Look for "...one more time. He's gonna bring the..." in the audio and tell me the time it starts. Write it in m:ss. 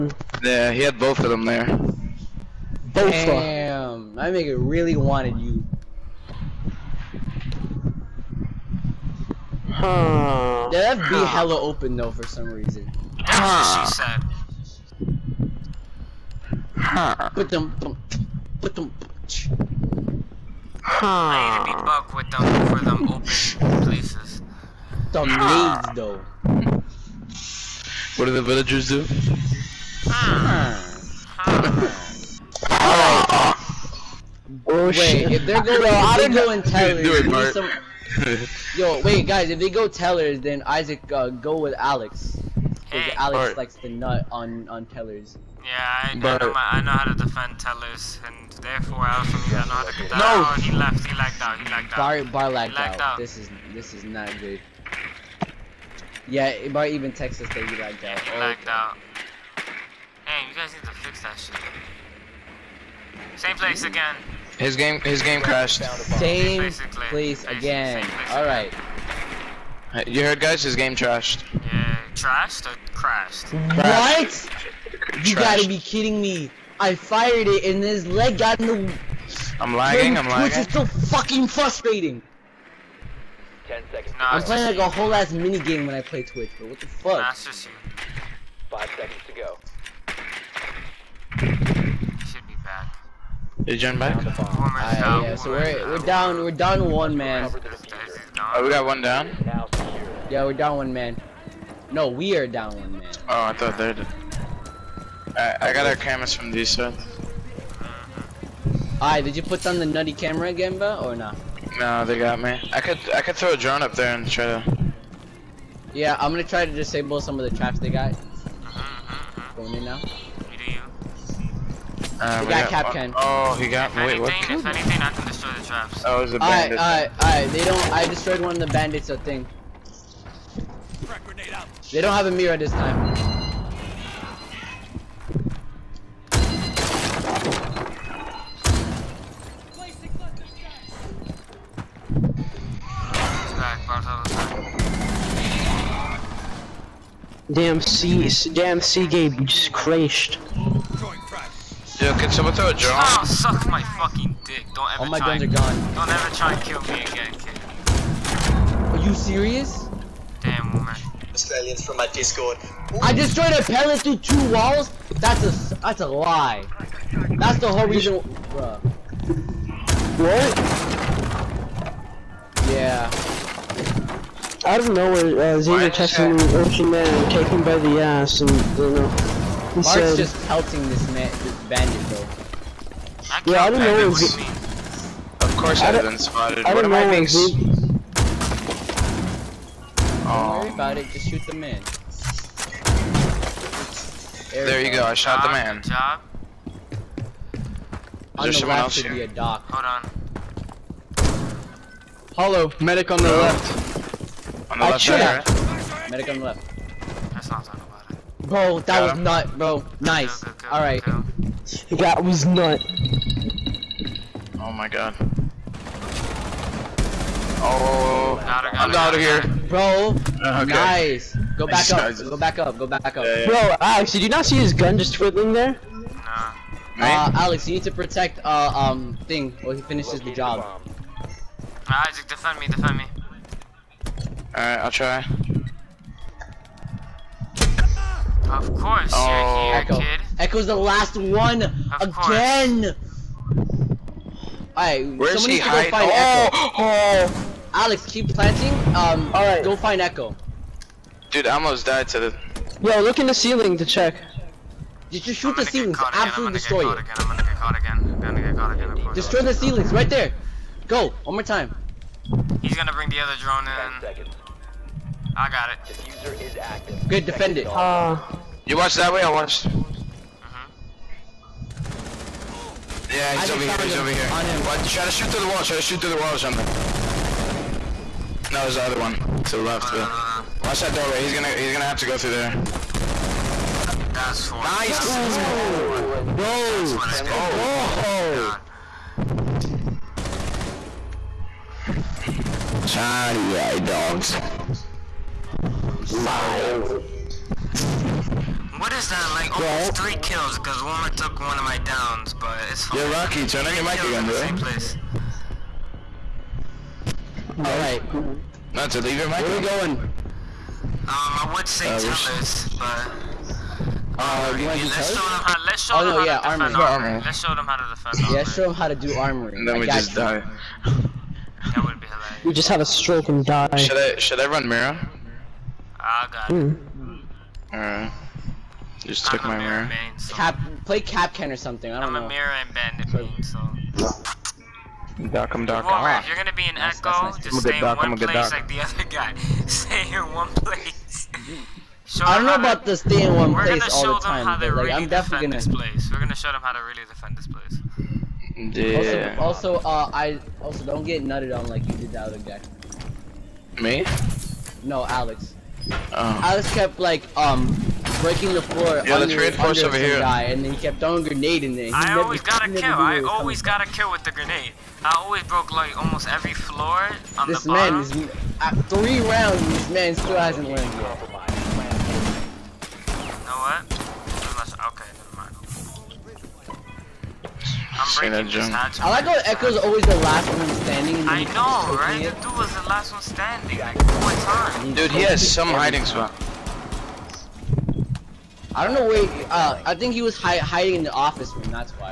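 4:21.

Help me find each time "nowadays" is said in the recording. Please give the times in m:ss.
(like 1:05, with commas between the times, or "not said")
not said.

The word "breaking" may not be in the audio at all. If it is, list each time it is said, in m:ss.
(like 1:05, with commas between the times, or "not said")
5:58, 6:18.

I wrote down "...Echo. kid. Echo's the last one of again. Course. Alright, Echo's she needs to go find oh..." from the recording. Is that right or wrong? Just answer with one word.
wrong.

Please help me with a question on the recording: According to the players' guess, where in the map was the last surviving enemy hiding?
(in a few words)
The office room.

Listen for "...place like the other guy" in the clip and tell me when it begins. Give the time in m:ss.
5:38.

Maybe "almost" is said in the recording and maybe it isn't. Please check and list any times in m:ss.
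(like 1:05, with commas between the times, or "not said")
4:11, 4:59, 6:05.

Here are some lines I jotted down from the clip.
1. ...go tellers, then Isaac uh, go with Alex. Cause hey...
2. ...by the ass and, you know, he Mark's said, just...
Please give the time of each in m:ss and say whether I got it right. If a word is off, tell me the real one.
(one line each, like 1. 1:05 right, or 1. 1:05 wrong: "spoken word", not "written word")
1. 0:39 right
2. 2:57 right.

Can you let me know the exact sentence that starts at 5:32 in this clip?
I'm a mirror and bandit so.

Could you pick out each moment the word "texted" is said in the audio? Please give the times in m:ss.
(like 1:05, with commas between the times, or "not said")
0:57, 2:55.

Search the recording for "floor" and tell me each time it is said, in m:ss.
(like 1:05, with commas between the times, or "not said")
5:58, 6:06.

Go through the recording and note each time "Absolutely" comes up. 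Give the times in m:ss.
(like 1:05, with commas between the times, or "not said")
4:16.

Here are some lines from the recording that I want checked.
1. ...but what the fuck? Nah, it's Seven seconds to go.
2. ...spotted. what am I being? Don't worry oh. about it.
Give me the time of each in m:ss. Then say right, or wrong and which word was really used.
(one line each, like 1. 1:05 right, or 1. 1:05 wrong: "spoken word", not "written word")
1. 1:26 wrong: "Five", not "Seven"
2. 3:06 right.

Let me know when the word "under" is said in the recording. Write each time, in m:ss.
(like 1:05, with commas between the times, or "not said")
5:59.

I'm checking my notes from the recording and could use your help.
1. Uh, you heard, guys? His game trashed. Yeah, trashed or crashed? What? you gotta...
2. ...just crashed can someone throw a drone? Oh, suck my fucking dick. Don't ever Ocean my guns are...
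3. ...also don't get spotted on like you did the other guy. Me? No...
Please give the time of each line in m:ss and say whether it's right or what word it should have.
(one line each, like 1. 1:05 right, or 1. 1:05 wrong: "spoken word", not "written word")
1. 1:09 right
2. 2:29 wrong: "All", not "Ocean"
3. 5:50 wrong: "nutted", not "spotted".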